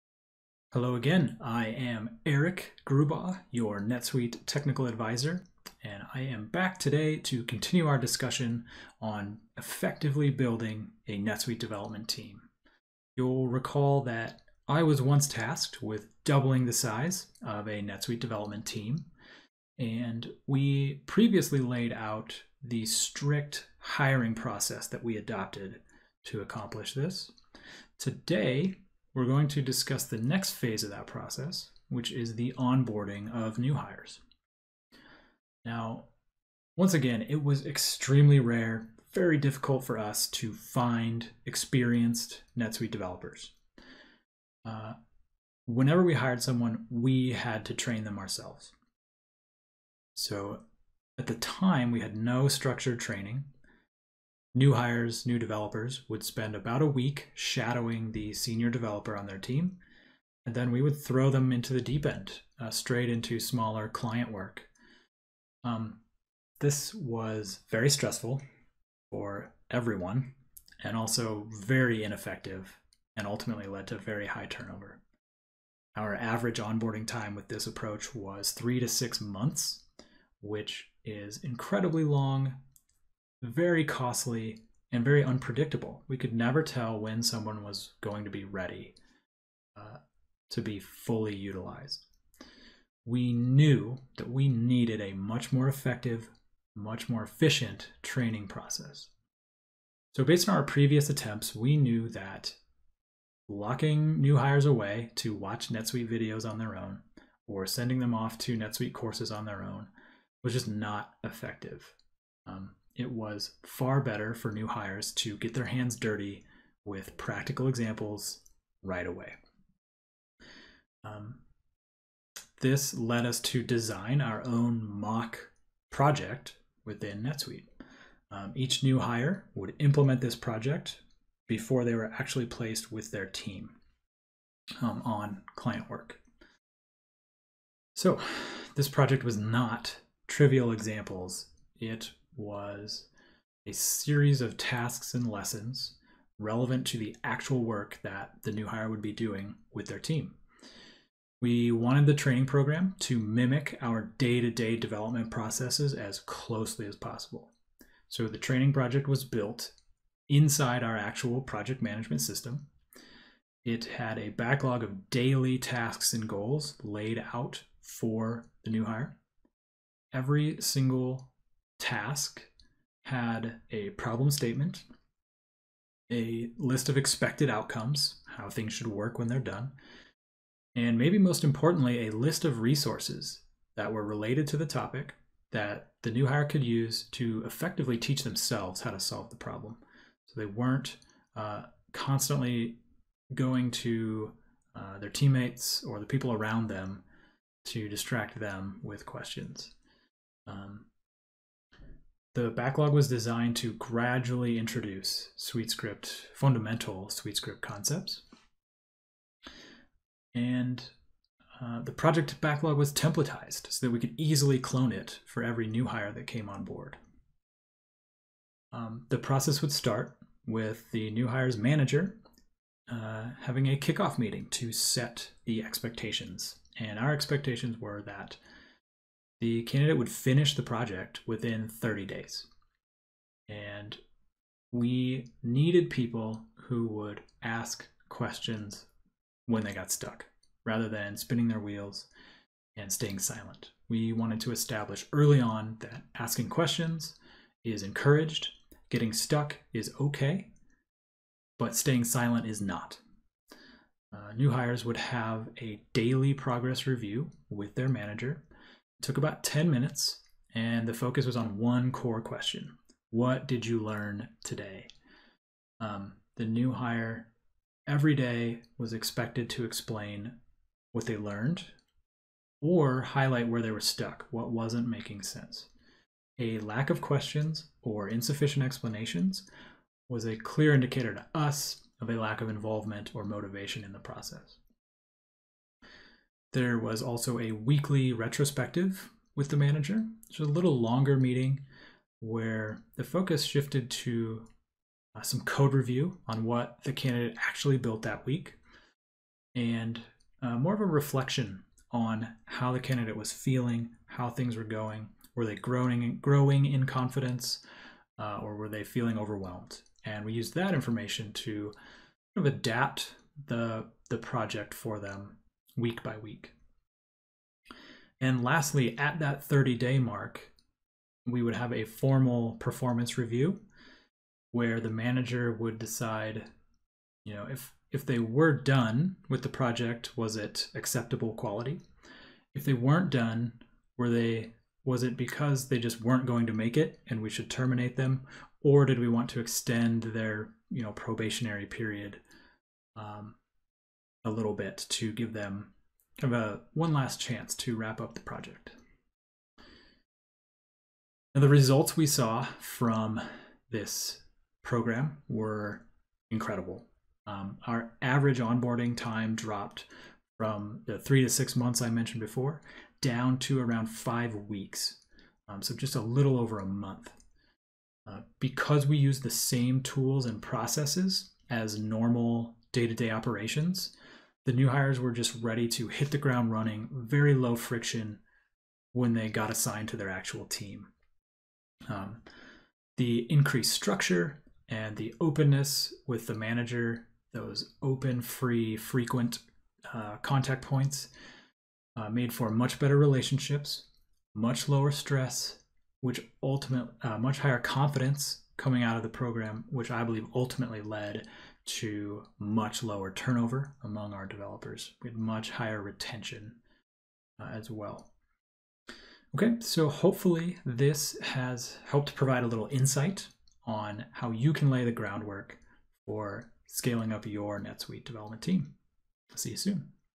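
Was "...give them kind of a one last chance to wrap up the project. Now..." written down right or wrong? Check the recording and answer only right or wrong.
right.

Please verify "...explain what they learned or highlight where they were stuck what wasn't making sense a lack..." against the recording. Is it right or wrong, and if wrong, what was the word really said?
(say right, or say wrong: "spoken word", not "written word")
right.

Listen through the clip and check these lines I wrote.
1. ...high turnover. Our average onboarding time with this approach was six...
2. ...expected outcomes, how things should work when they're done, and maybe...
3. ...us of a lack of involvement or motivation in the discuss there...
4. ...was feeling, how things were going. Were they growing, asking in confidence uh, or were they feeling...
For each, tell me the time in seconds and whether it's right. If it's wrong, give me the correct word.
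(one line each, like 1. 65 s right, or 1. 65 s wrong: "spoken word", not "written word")
1. 74 s wrong: "three", not "six"
2. 176 s right
3. 281 s wrong: "process", not "discuss"
4. 303 s wrong: "growing", not "asking".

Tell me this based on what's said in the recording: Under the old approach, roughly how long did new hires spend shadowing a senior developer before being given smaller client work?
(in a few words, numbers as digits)
about a week.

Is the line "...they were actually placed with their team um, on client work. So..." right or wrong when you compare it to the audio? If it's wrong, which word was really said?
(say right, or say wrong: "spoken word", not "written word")
right.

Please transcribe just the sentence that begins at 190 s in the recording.
So they weren't uh, constantly going to uh, their teammates or the people around them to distract them with questions.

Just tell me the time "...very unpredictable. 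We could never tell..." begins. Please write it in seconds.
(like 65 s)
85 s.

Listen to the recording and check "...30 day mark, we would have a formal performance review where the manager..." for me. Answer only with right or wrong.
right.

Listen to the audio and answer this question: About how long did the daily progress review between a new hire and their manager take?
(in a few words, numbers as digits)
about 10 minutes.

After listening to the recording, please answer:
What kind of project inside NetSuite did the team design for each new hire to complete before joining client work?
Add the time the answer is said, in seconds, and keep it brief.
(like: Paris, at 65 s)
mock project, at 124 s.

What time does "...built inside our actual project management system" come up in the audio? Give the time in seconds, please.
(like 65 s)
159 s.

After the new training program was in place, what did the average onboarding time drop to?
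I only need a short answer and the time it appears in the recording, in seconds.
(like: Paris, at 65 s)
around 5 weeks, at 363 s.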